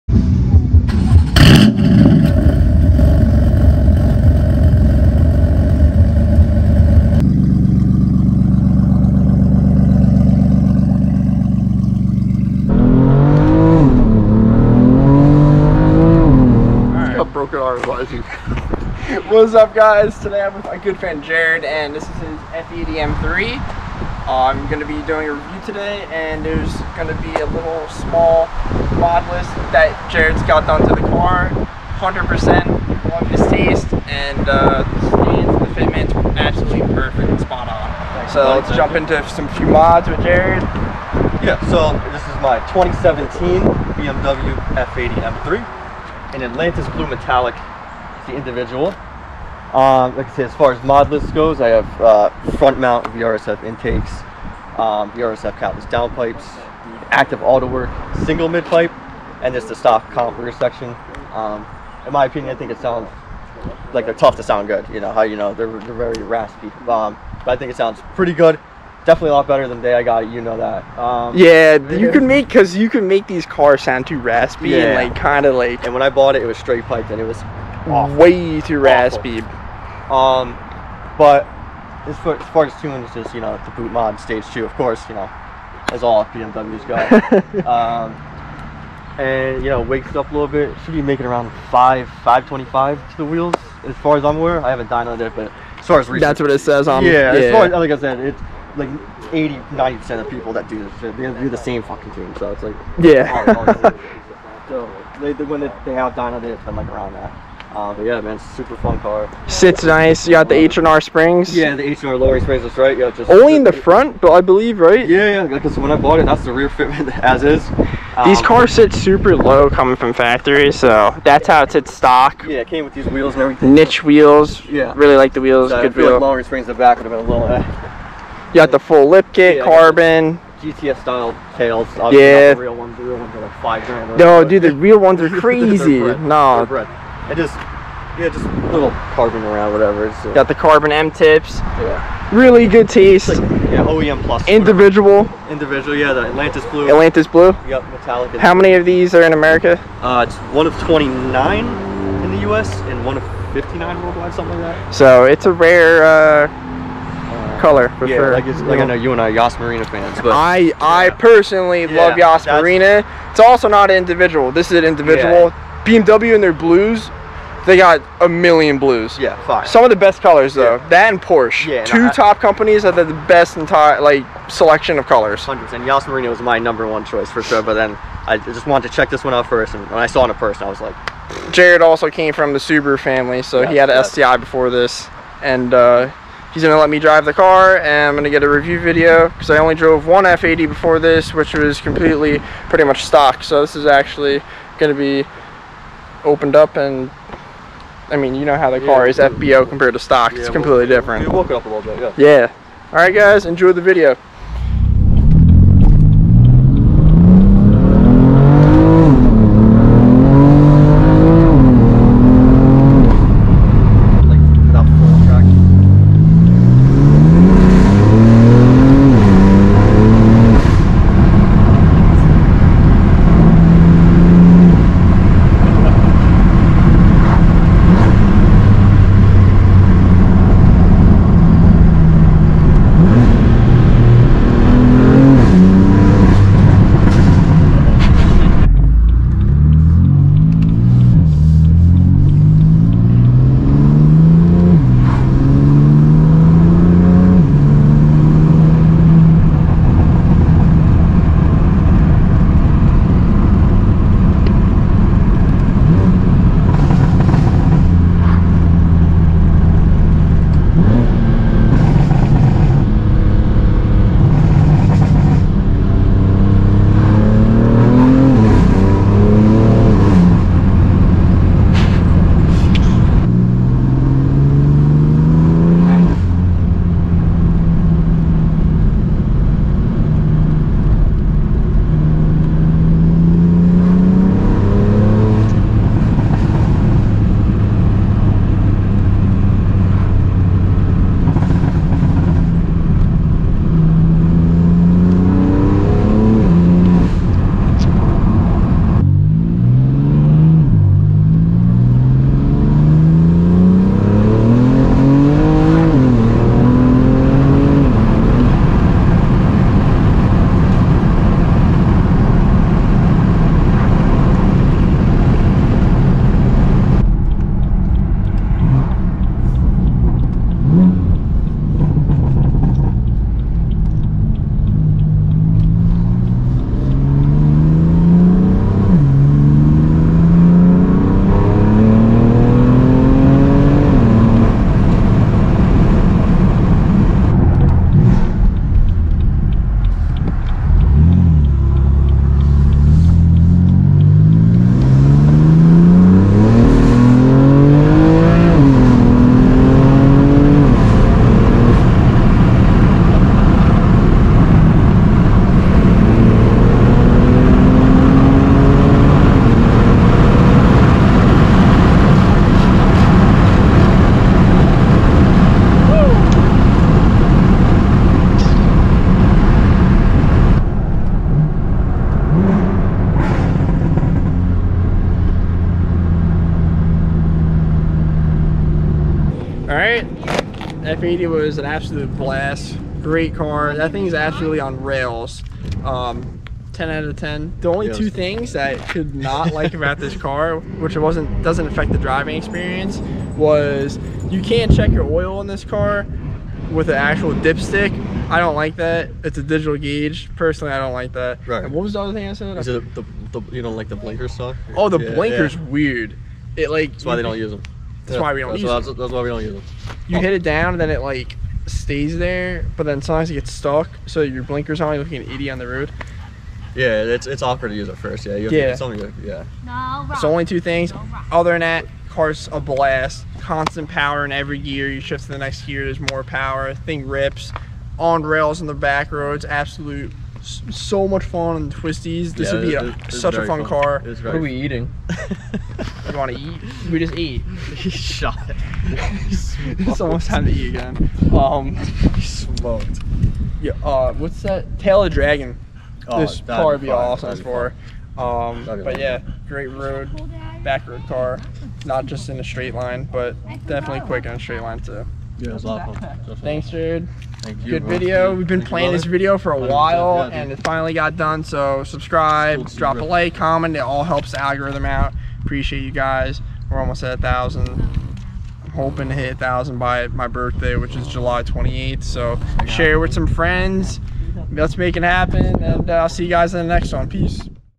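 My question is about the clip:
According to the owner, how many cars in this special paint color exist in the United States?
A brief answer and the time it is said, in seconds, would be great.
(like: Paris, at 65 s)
29, at 150 s.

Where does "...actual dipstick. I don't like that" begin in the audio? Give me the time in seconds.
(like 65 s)
396 s.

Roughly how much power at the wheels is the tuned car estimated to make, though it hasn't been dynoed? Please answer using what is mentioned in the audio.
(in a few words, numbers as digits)
525.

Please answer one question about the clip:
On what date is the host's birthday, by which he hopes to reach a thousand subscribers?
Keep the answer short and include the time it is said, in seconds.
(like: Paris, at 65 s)
July 28th, at 471 s.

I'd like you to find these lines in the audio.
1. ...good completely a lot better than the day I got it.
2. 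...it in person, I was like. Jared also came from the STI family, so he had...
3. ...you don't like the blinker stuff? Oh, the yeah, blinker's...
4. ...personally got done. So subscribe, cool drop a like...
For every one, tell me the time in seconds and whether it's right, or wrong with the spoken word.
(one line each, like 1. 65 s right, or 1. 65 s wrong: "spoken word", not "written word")
1. 68 s wrong: "definitely", not "completely"
2. 180 s wrong: "Subaru", not "STI"
3. 403 s right
4. 460 s wrong: "finally", not "personally".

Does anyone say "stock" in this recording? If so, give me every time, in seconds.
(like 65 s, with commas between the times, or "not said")
59 s, 121 s, 193 s, 199 s.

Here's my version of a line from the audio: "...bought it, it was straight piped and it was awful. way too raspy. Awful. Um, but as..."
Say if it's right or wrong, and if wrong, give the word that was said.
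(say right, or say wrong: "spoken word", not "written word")
right.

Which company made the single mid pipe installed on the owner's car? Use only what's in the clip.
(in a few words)
Active Autowerke.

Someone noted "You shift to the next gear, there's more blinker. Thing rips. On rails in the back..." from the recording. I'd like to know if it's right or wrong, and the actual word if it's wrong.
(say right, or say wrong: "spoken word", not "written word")
wrong: "power", not "blinker".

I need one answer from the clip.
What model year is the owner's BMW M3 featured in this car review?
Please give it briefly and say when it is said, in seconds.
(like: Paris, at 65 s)
2017, at 42 s.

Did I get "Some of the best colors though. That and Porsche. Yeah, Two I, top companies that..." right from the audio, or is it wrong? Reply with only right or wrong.
right.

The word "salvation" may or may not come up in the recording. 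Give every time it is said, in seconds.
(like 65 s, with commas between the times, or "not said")
not said.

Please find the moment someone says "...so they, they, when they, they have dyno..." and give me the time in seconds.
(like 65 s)
104 s.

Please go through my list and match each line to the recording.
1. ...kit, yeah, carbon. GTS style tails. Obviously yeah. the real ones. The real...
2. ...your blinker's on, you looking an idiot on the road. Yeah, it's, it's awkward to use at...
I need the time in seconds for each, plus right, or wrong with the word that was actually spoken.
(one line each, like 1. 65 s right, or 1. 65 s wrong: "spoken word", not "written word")
1. 129 s right
2. 414 s right.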